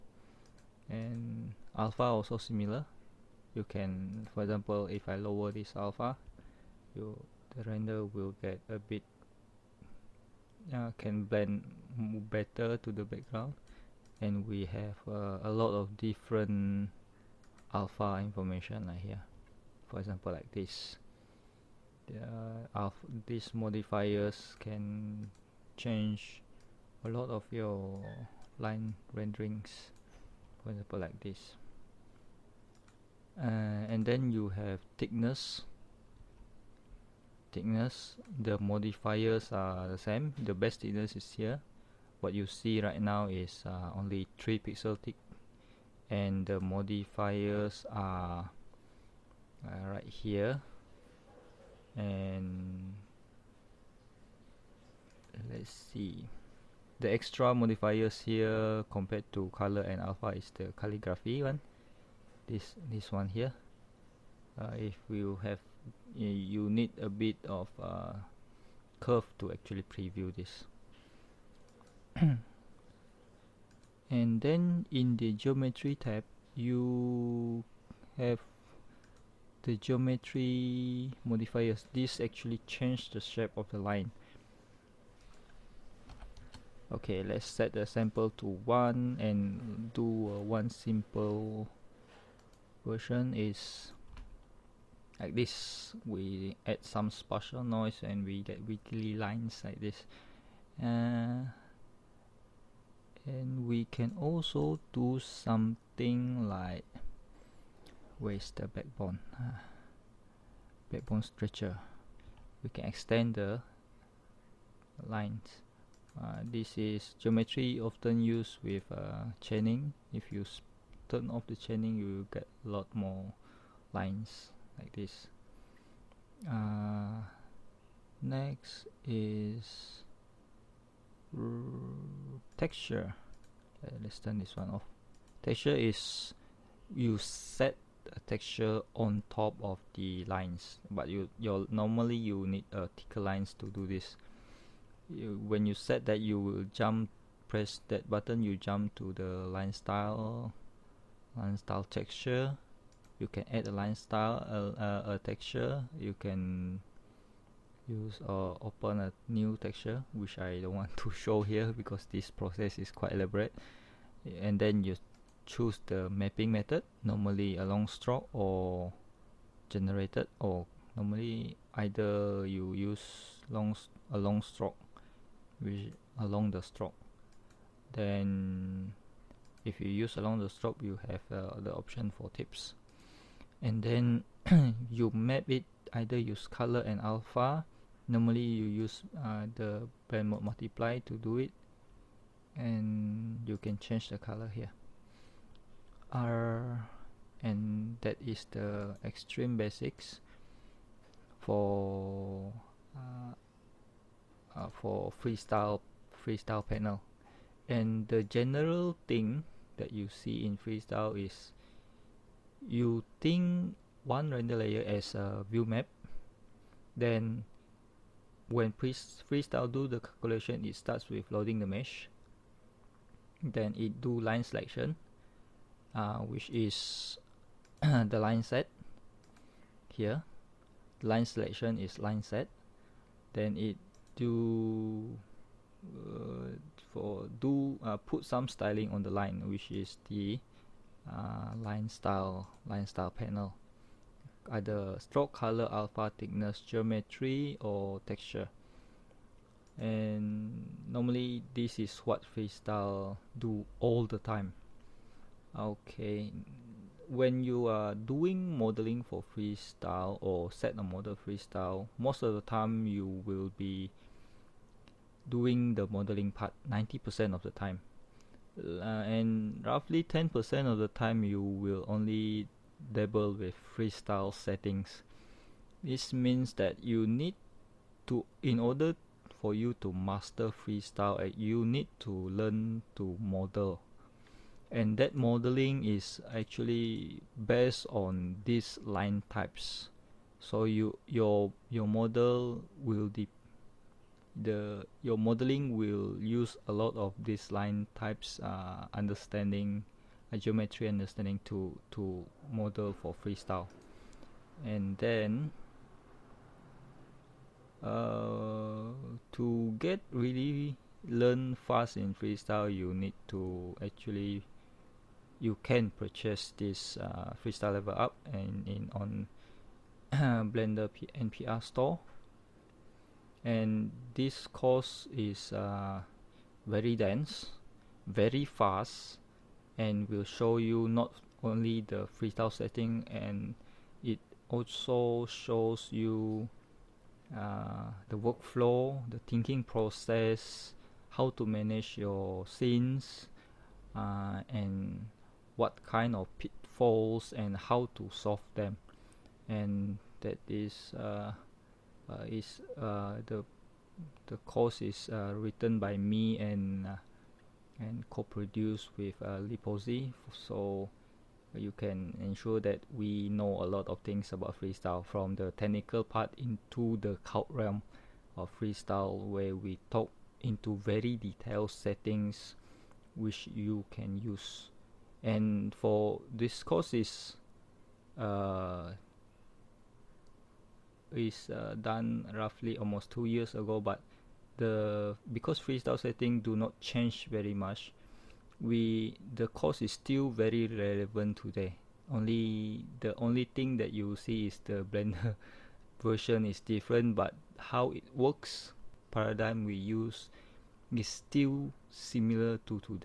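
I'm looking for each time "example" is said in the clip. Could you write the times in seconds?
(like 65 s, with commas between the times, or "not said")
4 s, 19 s, 30 s.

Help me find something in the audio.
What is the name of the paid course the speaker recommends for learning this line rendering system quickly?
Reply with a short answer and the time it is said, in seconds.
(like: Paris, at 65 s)
Freestyle Level Up, at 317 s.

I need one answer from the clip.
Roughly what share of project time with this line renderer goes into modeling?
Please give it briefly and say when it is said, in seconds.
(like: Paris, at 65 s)
90%, at 266 s.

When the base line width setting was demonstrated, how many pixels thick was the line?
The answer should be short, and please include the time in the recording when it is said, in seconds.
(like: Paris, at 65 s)
3, at 44 s.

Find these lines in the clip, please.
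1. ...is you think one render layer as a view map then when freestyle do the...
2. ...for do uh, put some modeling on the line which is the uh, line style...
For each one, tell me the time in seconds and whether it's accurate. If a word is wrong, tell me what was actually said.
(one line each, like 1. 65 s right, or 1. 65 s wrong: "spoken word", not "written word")
1. 211 s right
2. 236 s wrong: "styling", not "modeling".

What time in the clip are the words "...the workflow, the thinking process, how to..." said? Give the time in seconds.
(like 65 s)
338 s.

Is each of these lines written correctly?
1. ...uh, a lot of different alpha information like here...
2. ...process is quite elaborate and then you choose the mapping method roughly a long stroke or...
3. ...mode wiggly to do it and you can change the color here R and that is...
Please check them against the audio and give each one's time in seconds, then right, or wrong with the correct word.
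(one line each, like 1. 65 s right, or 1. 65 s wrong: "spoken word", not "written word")
1. 15 s right
2. 162 s wrong: "normally", not "roughly"
3. 190 s wrong: "multiply", not "wiggly".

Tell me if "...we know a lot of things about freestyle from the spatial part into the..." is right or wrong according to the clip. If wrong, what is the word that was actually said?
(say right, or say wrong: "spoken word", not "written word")
wrong: "technical", not "spatial".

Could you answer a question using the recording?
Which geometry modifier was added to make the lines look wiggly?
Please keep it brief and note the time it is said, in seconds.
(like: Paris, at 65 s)
Spatial noise, at 97 s.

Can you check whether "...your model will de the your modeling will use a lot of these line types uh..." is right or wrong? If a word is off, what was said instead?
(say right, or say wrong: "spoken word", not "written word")
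right.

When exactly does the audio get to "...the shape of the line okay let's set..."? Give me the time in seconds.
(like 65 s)
83 s.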